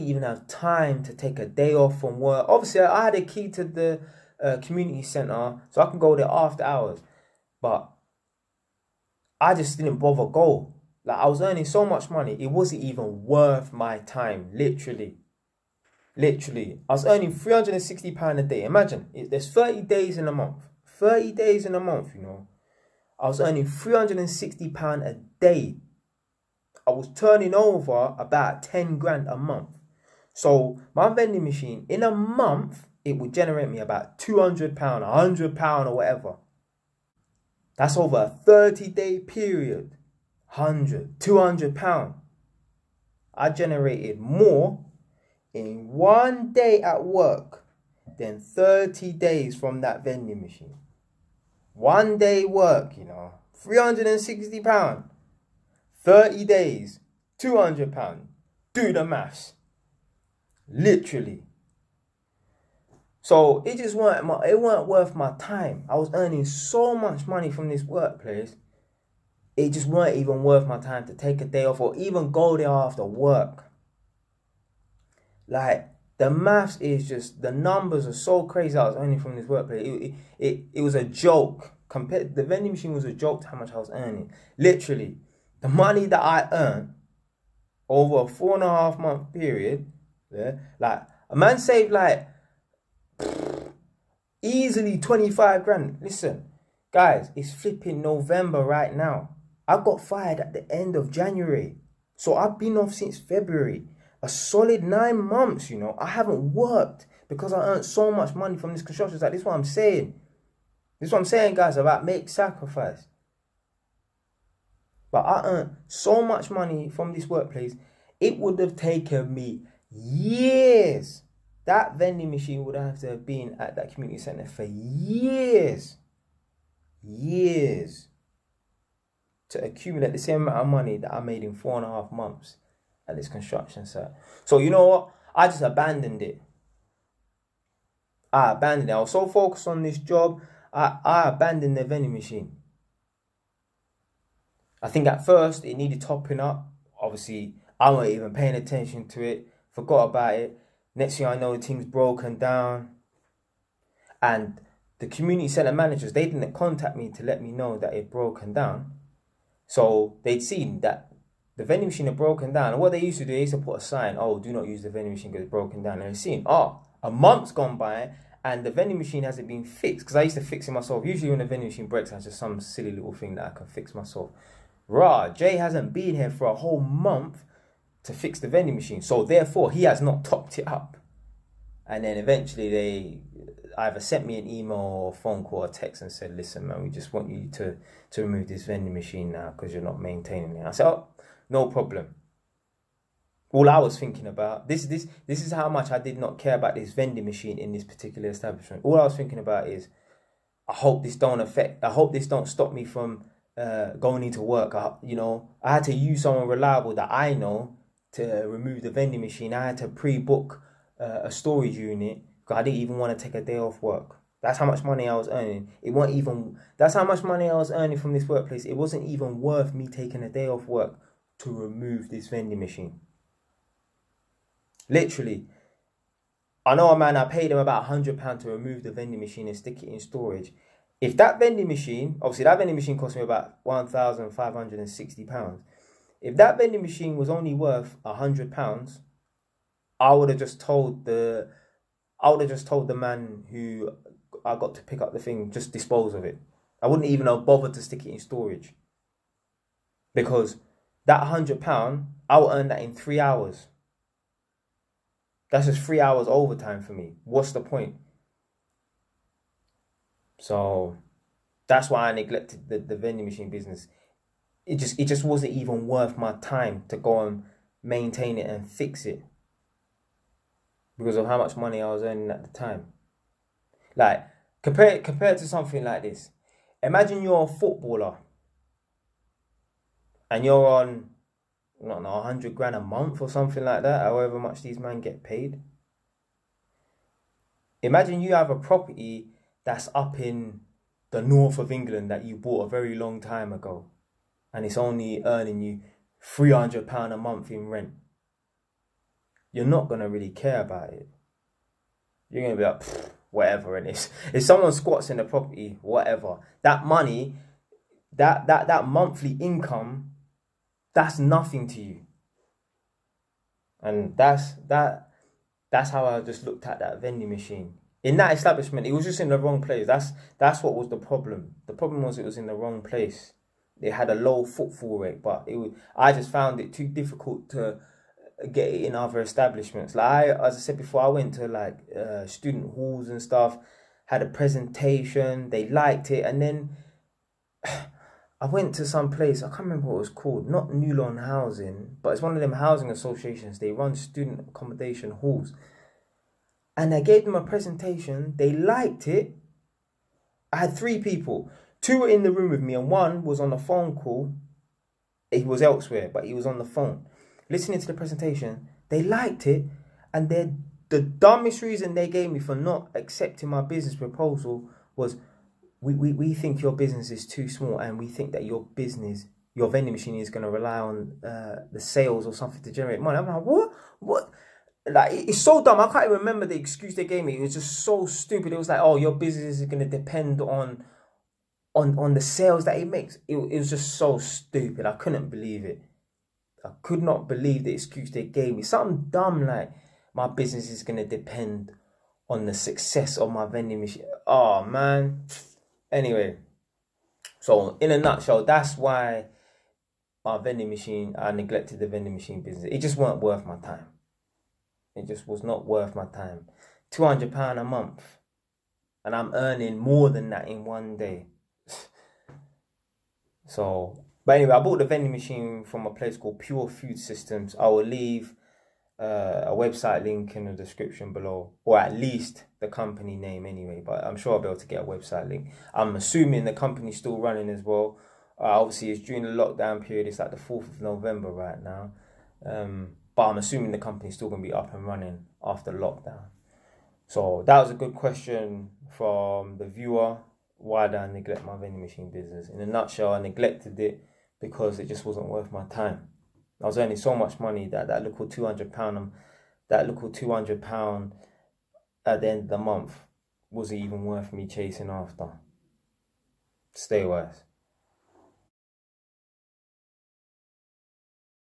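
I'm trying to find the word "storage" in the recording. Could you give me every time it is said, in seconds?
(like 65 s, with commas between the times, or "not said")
211 s, 229 s, 248 s.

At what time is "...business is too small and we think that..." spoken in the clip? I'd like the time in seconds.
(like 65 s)
366 s.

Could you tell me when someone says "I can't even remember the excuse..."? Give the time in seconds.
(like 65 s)
375 s.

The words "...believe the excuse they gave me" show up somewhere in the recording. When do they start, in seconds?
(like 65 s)
387 s.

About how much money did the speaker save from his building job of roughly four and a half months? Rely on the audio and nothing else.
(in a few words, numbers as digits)
25 grand.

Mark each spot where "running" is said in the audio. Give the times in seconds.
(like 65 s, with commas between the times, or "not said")
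427 s, 434 s.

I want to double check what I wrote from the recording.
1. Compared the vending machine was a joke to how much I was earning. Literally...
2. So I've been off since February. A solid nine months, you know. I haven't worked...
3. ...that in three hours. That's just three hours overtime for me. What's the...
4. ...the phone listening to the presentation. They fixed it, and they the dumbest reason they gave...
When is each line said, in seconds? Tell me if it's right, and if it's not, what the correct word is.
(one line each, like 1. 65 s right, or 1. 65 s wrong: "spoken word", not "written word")
1. 81 s right
2. 102 s right
3. 252 s right
4. 356 s wrong: "liked", not "fixed".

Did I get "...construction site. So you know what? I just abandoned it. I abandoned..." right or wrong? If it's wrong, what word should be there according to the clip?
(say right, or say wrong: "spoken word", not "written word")
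right.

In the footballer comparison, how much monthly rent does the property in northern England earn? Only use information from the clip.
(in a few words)
£300.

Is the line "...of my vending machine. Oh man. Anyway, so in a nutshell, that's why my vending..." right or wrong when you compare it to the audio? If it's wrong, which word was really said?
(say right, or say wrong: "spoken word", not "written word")
right.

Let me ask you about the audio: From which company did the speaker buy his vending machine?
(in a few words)
Pure Food Systems.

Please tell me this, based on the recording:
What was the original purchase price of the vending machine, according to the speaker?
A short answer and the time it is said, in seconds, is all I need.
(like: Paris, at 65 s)
£1,560, at 233 s.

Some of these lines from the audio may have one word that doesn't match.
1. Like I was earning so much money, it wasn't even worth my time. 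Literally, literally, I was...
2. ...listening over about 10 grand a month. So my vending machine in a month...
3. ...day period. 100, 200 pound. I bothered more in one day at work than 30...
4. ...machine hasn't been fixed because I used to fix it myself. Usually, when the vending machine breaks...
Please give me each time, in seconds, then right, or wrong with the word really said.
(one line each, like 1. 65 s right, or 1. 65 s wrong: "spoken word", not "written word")
1. 11 s right
2. 27 s wrong: "turning", not "listening"
3. 38 s wrong: "generated", not "bothered"
4. 168 s right.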